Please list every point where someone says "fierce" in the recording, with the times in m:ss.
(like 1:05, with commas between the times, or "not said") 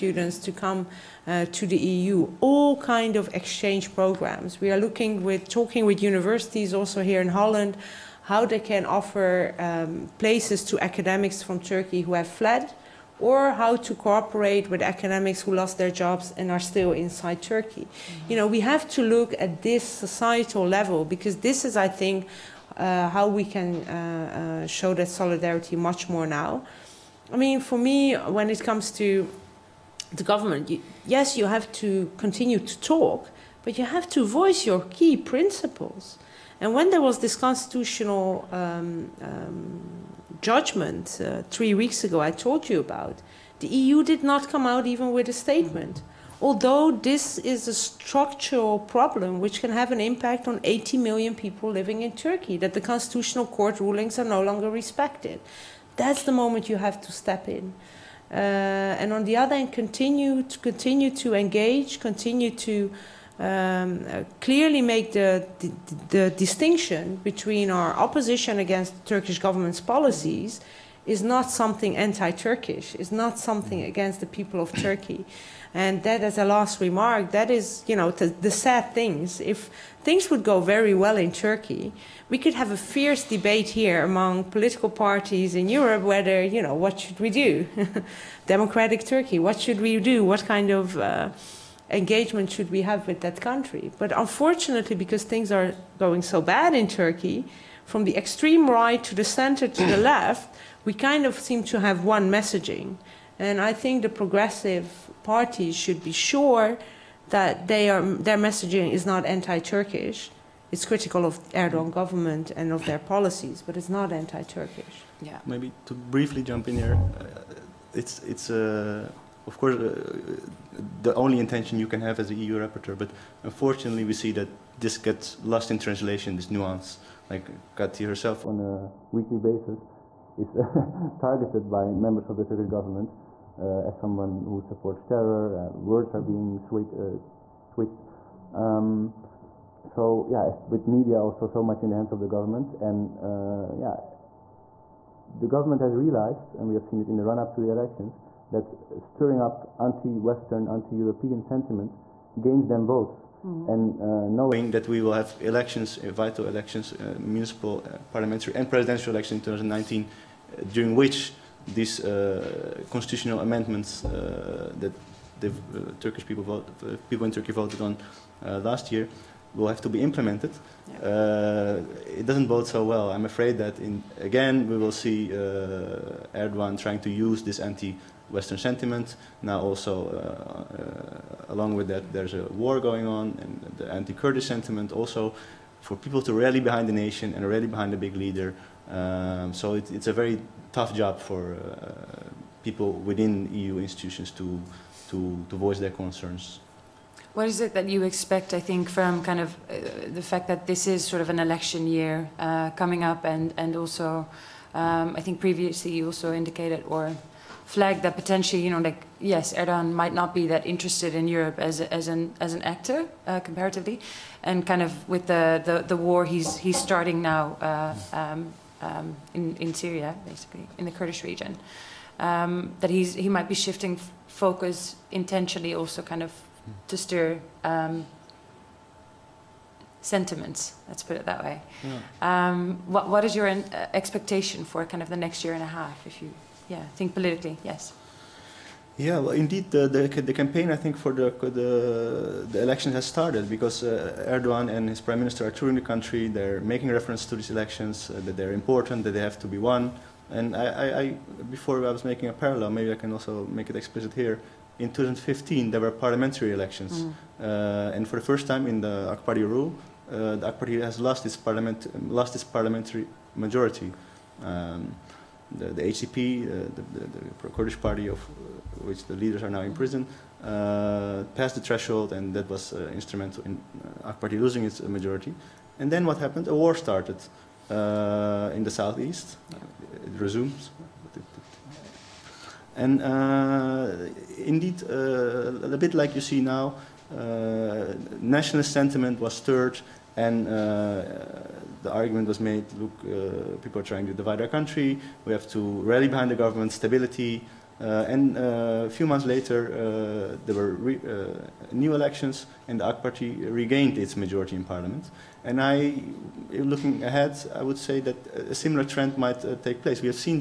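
1:22.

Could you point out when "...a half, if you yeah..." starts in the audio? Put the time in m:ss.
3:55.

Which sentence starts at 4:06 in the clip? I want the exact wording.
They're making reference to these elections, uh, that they're important, that they have to be won.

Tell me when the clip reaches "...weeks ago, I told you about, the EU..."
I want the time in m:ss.
0:41.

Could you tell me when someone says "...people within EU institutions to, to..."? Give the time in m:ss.
3:12.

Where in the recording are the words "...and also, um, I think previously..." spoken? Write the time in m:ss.
3:23.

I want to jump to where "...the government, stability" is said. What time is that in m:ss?
4:56.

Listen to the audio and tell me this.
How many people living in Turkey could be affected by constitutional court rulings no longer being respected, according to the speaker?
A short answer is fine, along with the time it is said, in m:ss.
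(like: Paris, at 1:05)
80 million, at 0:50.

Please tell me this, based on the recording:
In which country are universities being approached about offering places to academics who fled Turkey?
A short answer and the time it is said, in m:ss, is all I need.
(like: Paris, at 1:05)
Holland, at 0:07.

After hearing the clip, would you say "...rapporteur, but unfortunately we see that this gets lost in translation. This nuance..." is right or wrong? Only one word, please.
right.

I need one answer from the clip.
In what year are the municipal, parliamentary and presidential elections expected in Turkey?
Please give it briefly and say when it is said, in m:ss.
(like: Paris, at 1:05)
2019, at 2:39.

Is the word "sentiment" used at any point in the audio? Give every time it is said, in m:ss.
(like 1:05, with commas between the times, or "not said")
2:31, 2:58, 3:04, 3:49, 4:48.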